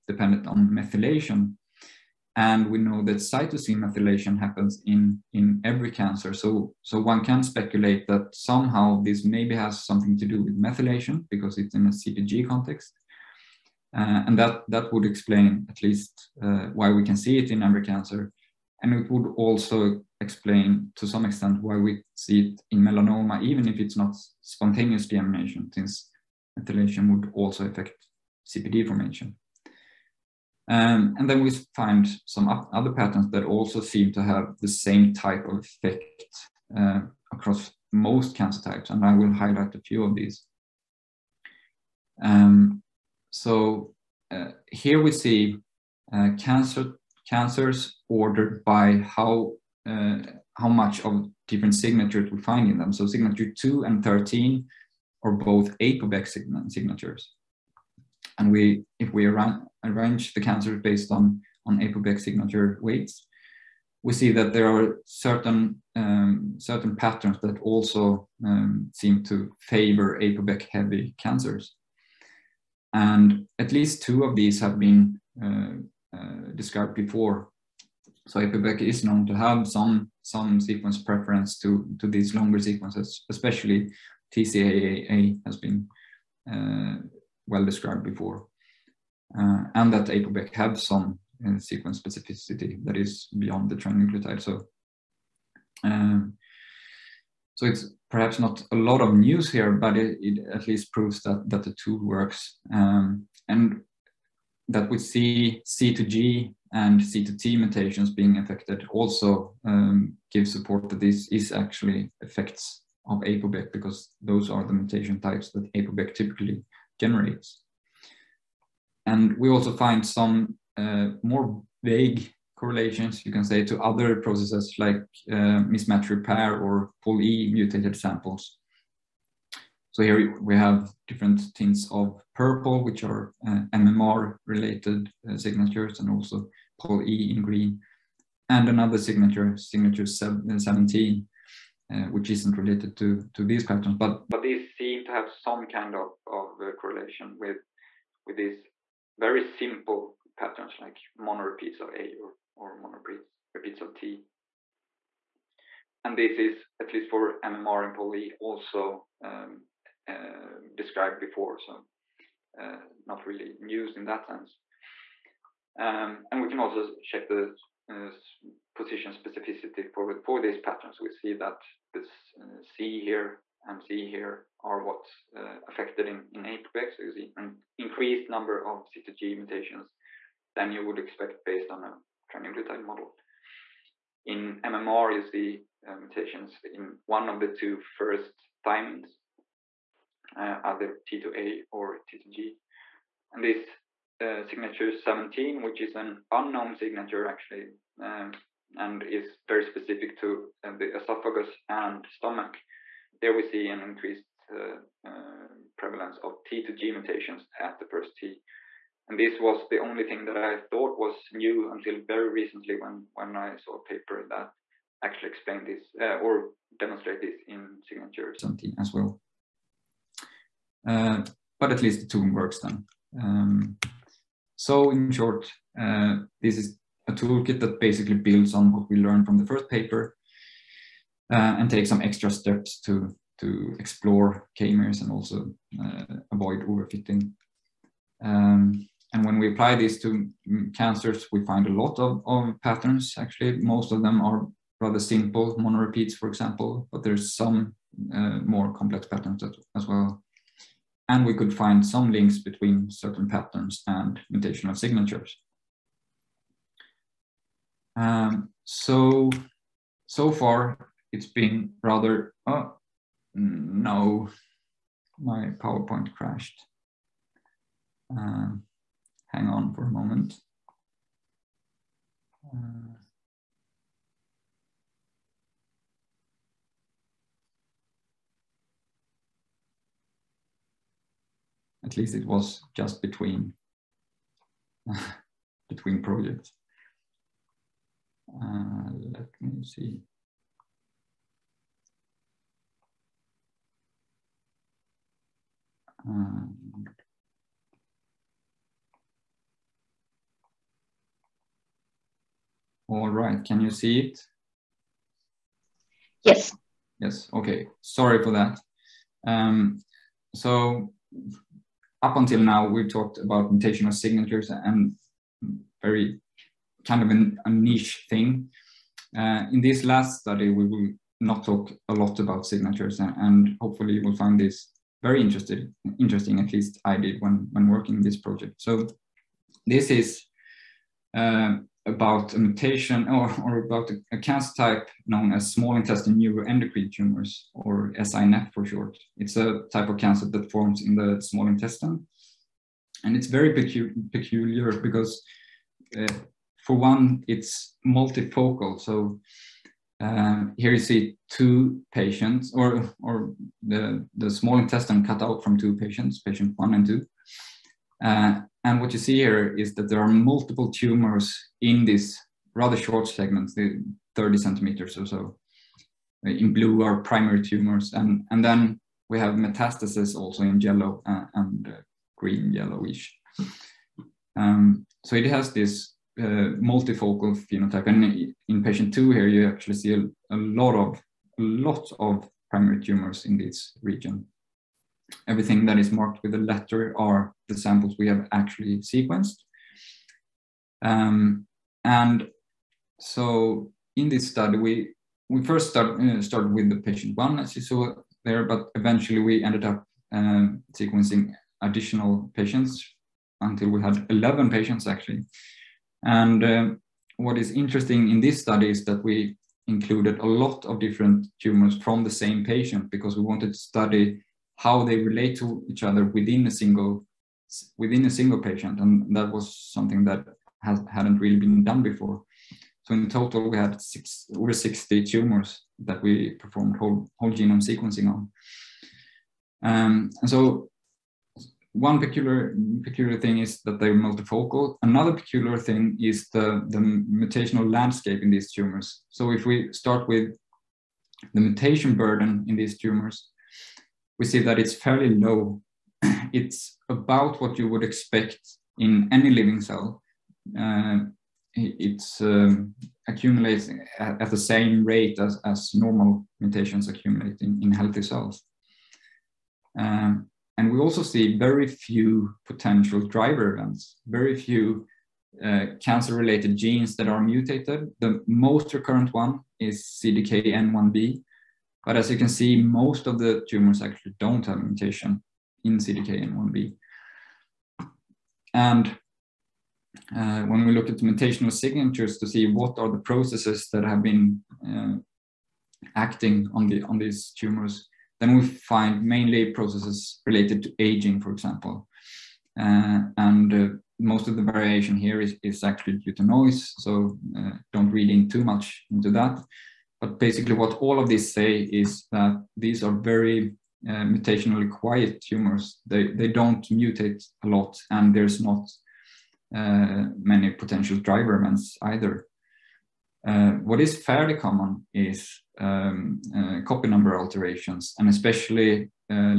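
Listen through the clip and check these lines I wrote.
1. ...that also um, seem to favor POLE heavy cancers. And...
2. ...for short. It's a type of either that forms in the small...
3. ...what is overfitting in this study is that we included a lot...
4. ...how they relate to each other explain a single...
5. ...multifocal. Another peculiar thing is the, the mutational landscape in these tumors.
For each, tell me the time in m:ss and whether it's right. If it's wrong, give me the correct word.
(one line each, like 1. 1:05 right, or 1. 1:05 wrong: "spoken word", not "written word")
1. 1:07 wrong: "APOBEC", not "POLE"
2. 5:38 wrong: "cancer", not "either"
3. 6:47 wrong: "interesting", not "overfitting"
4. 6:54 wrong: "within", not "explain"
5. 7:13 right.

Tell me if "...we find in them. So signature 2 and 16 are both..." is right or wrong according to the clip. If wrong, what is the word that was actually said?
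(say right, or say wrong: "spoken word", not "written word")
wrong: "13", not "16".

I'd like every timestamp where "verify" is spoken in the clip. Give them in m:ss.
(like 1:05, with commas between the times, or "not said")
not said.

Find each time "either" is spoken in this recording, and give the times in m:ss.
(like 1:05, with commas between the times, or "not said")
3:10, 8:31.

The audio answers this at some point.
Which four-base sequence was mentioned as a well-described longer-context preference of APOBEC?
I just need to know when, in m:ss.
1:24.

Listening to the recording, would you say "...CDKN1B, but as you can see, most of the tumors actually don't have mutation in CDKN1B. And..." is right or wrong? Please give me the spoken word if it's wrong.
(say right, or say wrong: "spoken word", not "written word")
right.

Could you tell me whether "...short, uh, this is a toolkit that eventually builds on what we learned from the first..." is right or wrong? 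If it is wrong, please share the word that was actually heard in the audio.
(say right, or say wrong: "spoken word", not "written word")
wrong: "basically", not "eventually".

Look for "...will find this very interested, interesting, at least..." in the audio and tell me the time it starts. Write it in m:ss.
5:24.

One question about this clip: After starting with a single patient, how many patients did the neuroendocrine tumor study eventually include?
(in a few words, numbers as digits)
11.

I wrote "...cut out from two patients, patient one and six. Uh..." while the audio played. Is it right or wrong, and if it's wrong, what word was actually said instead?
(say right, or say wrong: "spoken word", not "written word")
wrong: "two", not "six".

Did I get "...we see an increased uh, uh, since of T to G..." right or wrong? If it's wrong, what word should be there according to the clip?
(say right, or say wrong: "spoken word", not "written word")
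wrong: "prevalence", not "since".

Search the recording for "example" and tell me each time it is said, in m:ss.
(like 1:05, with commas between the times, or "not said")
4:06, 8:11.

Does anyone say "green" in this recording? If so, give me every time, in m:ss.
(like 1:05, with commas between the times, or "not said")
2:17, 6:12.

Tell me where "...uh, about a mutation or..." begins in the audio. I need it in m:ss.
5:31.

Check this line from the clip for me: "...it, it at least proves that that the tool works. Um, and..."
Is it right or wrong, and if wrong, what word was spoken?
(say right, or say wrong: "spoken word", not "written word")
right.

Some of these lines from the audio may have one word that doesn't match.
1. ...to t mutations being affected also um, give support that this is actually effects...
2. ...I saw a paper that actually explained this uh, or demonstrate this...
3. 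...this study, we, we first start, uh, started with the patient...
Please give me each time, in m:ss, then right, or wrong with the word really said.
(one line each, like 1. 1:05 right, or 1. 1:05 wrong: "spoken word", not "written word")
1. 1:47 right
2. 3:33 right
3. 6:34 right.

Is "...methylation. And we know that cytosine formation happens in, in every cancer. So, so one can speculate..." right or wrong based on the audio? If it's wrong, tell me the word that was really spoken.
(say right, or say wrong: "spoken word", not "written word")
wrong: "methylation", not "formation".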